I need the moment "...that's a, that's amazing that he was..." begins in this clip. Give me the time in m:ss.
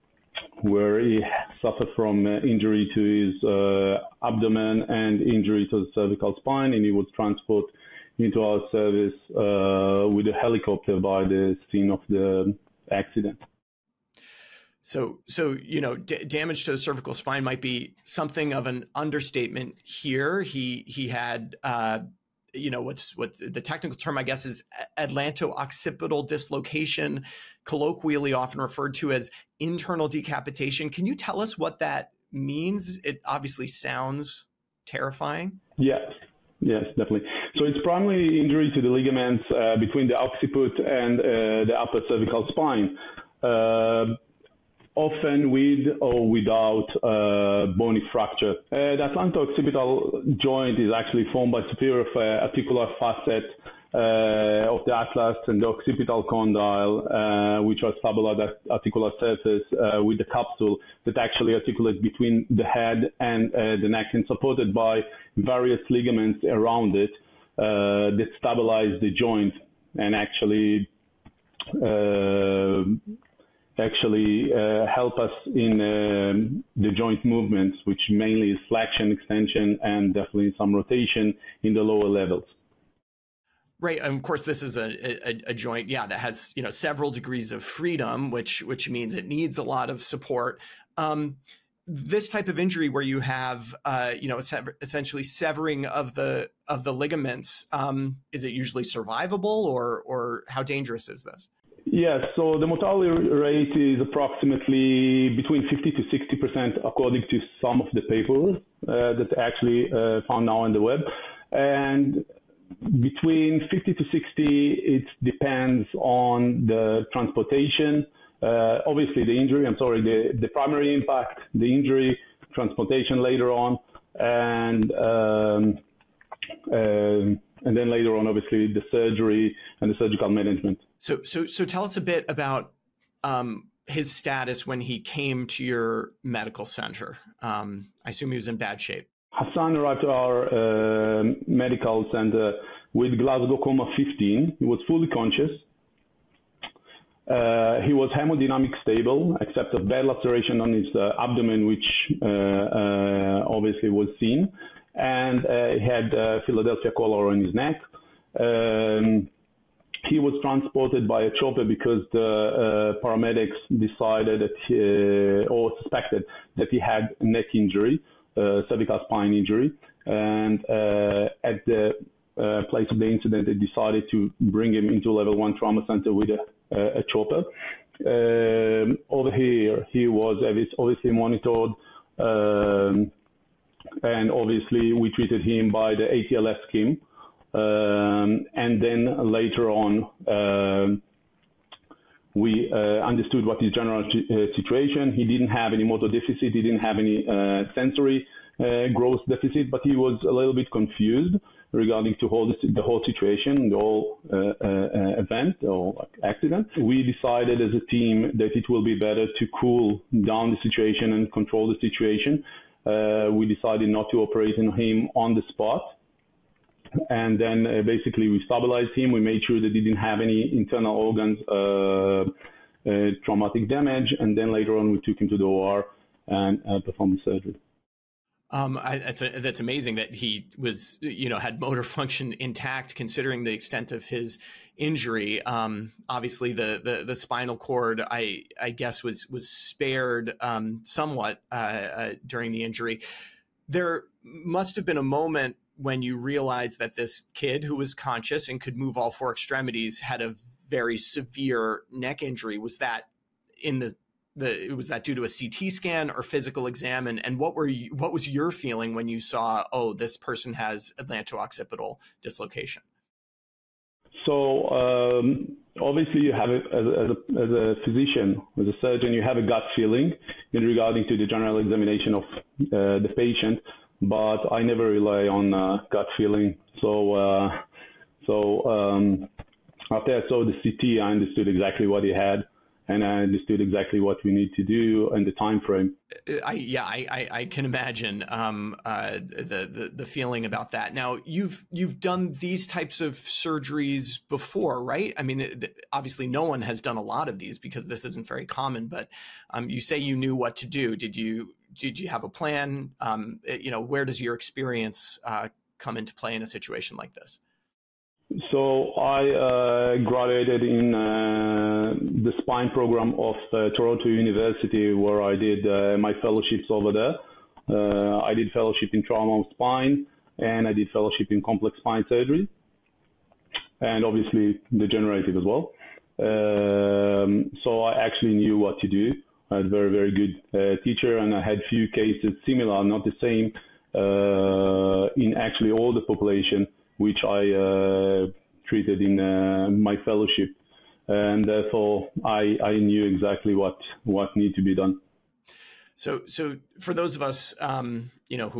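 3:48.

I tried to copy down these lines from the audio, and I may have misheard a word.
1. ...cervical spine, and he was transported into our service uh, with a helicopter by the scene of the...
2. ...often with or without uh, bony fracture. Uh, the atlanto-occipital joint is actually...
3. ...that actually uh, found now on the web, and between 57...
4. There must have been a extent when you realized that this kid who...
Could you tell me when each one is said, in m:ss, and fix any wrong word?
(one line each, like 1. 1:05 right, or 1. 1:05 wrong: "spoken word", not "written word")
1. 0:05 right
2. 0:44 right
3. 1:49 wrong: "50", not "57"
4. 4:03 wrong: "moment", not "extent".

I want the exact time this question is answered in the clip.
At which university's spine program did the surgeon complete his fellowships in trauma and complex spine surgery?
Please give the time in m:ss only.
5:13.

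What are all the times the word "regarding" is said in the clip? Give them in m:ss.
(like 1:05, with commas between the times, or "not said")
3:21, 4:30.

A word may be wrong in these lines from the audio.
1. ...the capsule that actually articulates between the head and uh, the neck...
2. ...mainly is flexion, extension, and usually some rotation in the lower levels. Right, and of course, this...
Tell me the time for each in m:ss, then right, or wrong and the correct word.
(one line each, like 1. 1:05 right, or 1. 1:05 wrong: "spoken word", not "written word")
1. 1:00 right
2. 1:18 wrong: "definitely", not "usually".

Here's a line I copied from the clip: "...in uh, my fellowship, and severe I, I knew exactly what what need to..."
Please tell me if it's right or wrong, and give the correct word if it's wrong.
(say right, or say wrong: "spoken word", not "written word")
wrong: "therefore", not "severe".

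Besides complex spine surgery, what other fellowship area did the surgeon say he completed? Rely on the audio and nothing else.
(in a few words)
Trauma of spine.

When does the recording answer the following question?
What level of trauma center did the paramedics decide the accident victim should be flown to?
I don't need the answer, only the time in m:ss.
2:55.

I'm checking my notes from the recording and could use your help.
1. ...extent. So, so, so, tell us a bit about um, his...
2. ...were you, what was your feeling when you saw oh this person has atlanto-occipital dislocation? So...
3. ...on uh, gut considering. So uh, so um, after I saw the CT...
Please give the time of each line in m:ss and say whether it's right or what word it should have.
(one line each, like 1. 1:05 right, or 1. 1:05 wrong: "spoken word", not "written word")
1. 2:10 wrong: "management", not "extent"
2. 4:17 right
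3. 4:35 wrong: "feeling", not "considering".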